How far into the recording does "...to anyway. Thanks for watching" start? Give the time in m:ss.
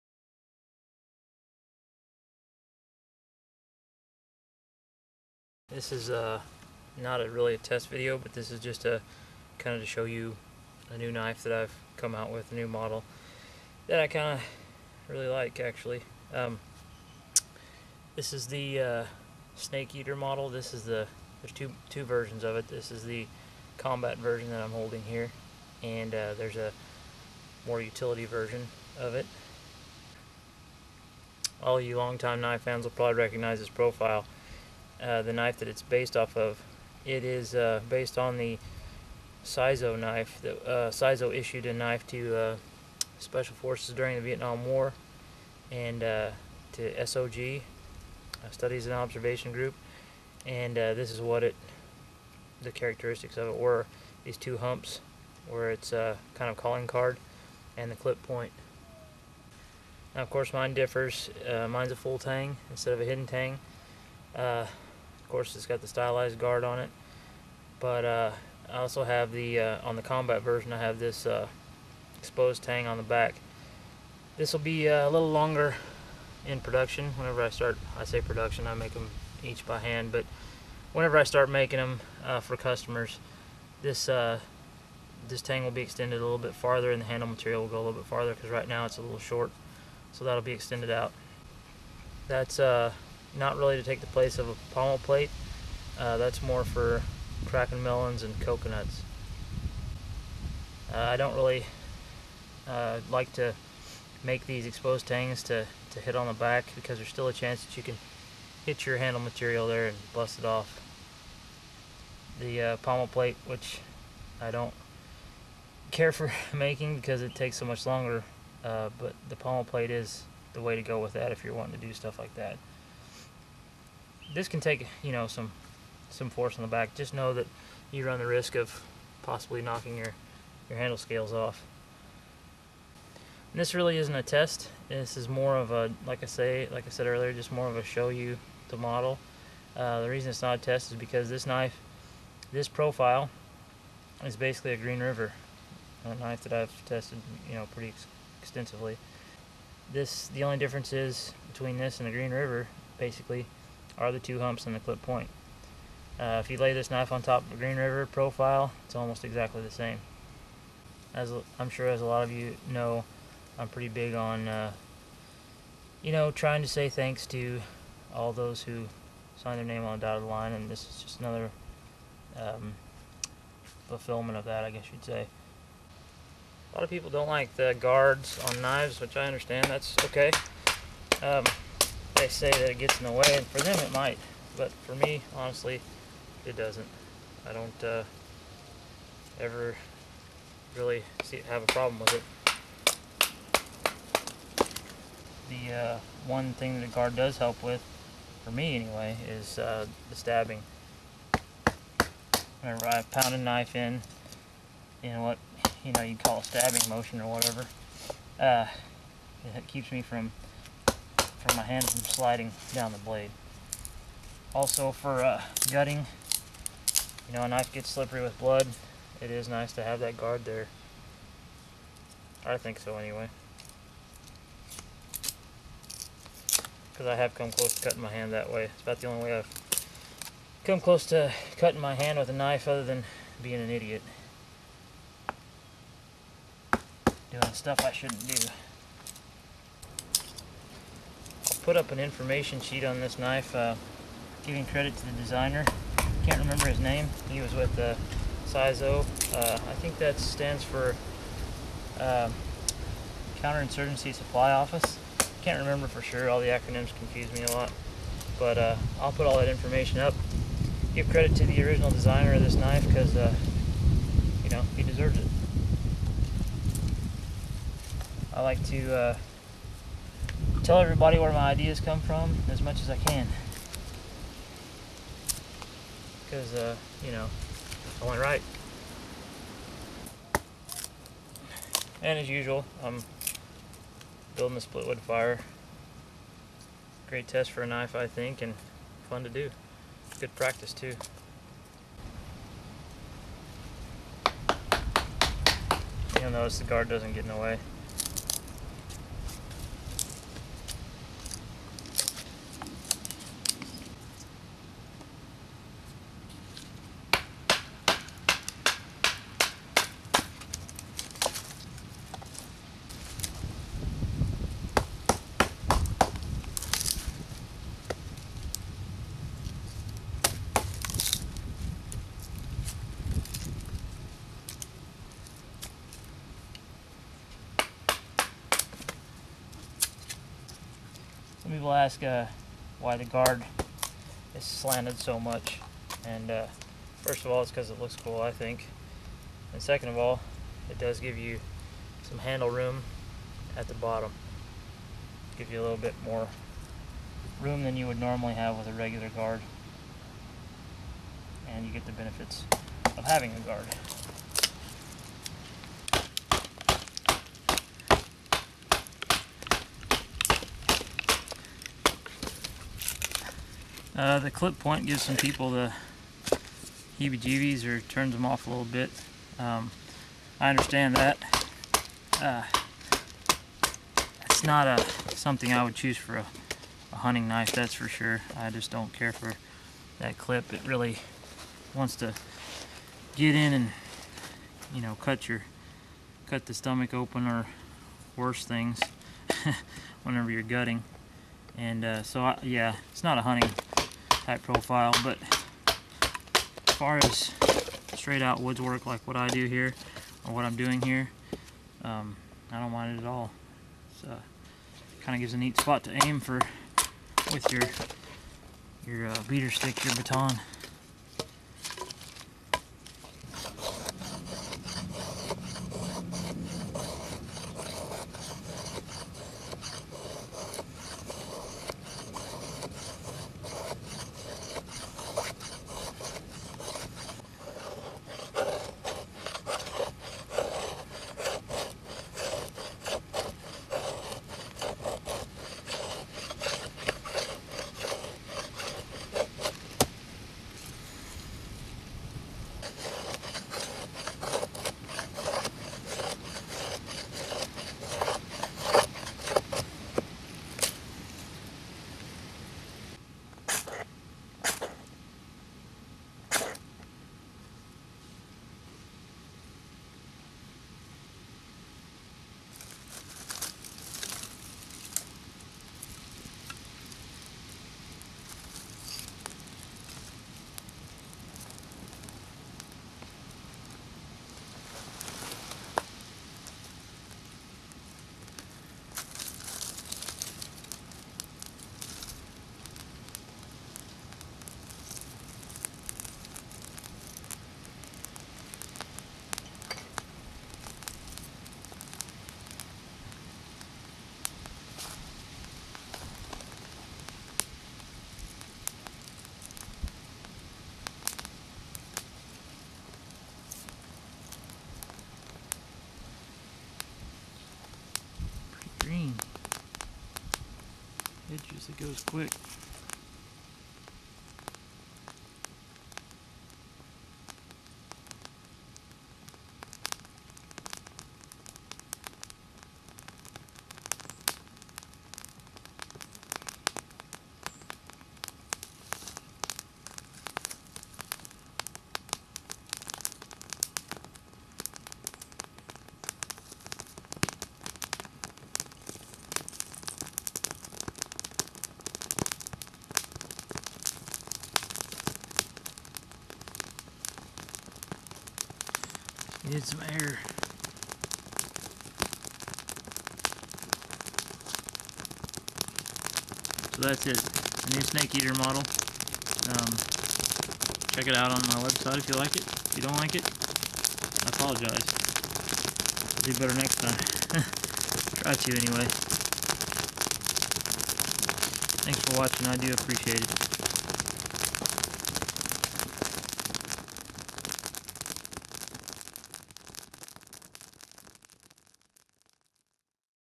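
9:28.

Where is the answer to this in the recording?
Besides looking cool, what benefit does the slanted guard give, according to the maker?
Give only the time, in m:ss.
5:42.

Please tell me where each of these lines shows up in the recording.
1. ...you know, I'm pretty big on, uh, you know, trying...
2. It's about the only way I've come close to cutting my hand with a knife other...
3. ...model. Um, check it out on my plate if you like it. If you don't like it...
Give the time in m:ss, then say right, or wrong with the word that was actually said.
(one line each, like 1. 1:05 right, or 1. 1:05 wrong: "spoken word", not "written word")
1. 2:42 right
2. 3:48 right
3. 9:18 wrong: "website", not "plate".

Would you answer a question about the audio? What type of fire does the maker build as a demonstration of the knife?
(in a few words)
split wood fire.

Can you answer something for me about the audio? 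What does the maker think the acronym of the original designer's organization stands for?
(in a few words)
Counterinsurgency Supply Office.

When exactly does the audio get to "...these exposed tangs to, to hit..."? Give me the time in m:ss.
1:44.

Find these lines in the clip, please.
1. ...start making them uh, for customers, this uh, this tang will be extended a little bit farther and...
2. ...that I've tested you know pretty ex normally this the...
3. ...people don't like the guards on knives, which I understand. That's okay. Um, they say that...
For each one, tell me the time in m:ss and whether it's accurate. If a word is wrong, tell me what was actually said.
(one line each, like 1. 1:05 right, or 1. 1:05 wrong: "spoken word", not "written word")
1. 1:21 right
2. 2:26 wrong: "extensively", not "normally"
3. 2:56 right.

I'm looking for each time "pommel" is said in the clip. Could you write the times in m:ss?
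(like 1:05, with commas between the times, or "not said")
1:34, 1:52, 1:59.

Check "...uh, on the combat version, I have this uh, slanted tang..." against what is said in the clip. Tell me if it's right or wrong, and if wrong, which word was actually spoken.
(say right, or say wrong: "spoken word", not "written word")
wrong: "exposed", not "slanted".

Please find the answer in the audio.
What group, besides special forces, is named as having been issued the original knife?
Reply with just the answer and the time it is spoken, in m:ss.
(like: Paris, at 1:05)
Studies and Observation Group, at 0:48.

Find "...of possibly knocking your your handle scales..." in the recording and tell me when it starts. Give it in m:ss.
2:08.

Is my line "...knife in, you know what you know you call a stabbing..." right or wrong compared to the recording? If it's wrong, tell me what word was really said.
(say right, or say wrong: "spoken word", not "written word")
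right.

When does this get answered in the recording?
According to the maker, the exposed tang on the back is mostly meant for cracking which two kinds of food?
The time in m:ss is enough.
1:37.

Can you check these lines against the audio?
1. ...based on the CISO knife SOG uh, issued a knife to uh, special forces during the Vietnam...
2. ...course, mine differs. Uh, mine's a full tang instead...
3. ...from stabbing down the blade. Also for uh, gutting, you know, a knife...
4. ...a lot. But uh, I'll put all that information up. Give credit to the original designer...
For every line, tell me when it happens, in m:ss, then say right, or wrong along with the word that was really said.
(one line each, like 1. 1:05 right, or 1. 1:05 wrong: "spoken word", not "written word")
1. 0:37 wrong: "The", not "SOG"
2. 1:00 right
3. 3:31 wrong: "sliding", not "stabbing"
4. 4:17 right.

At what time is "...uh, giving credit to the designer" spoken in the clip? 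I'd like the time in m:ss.
4:03.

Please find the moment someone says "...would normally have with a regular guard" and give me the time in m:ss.
5:47.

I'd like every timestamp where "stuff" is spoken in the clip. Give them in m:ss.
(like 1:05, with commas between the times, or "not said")
2:01, 3:57.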